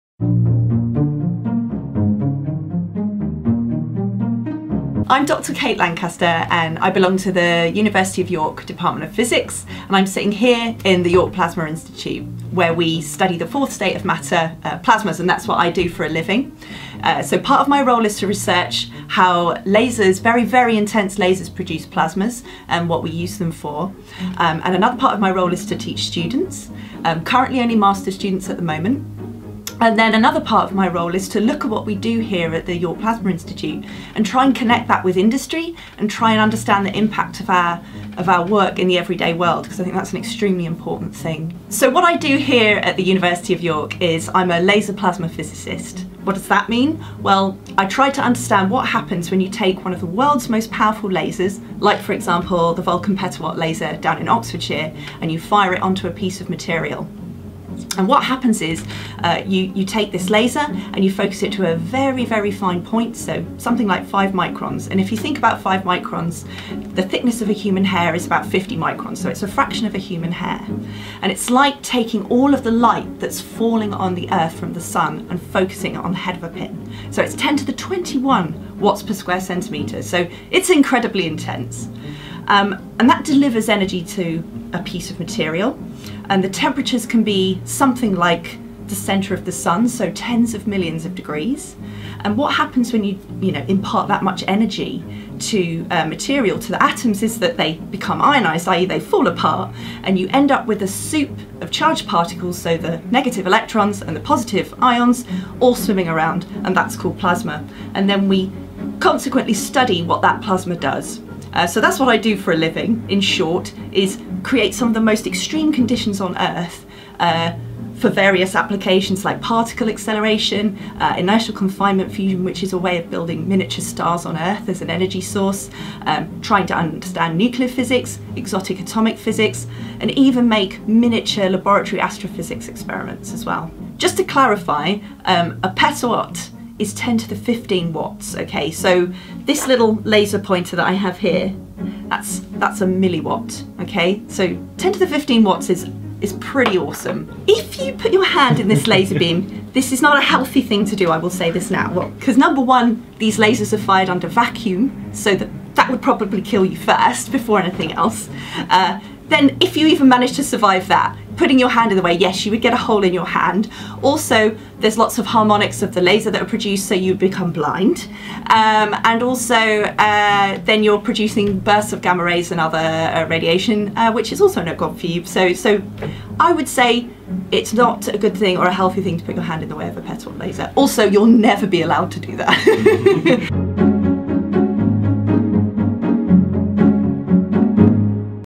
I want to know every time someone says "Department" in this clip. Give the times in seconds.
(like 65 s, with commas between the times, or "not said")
8 s.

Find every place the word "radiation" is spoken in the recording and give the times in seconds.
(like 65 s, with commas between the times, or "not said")
173 s.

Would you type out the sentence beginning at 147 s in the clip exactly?
If you put your hand in this laser beam, this is not a healthy thing to do, I will say this now.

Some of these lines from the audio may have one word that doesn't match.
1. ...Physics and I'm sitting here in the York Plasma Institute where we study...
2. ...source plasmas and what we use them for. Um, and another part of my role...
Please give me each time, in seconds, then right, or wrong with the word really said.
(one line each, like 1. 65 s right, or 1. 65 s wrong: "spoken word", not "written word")
1. 9 s right
2. 21 s wrong: "produce", not "source".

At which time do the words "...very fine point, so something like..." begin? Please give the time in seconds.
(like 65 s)
62 s.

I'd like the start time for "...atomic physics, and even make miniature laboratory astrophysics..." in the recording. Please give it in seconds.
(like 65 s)
128 s.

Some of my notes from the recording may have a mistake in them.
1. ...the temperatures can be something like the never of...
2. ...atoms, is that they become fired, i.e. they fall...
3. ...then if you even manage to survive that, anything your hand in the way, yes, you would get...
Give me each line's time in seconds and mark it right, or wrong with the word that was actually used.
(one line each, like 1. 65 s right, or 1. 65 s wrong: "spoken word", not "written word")
1. 86 s wrong: "center", not "never"
2. 96 s wrong: "ionized", not "fired"
3. 159 s wrong: "putting", not "anything".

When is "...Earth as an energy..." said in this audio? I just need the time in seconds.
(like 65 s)
124 s.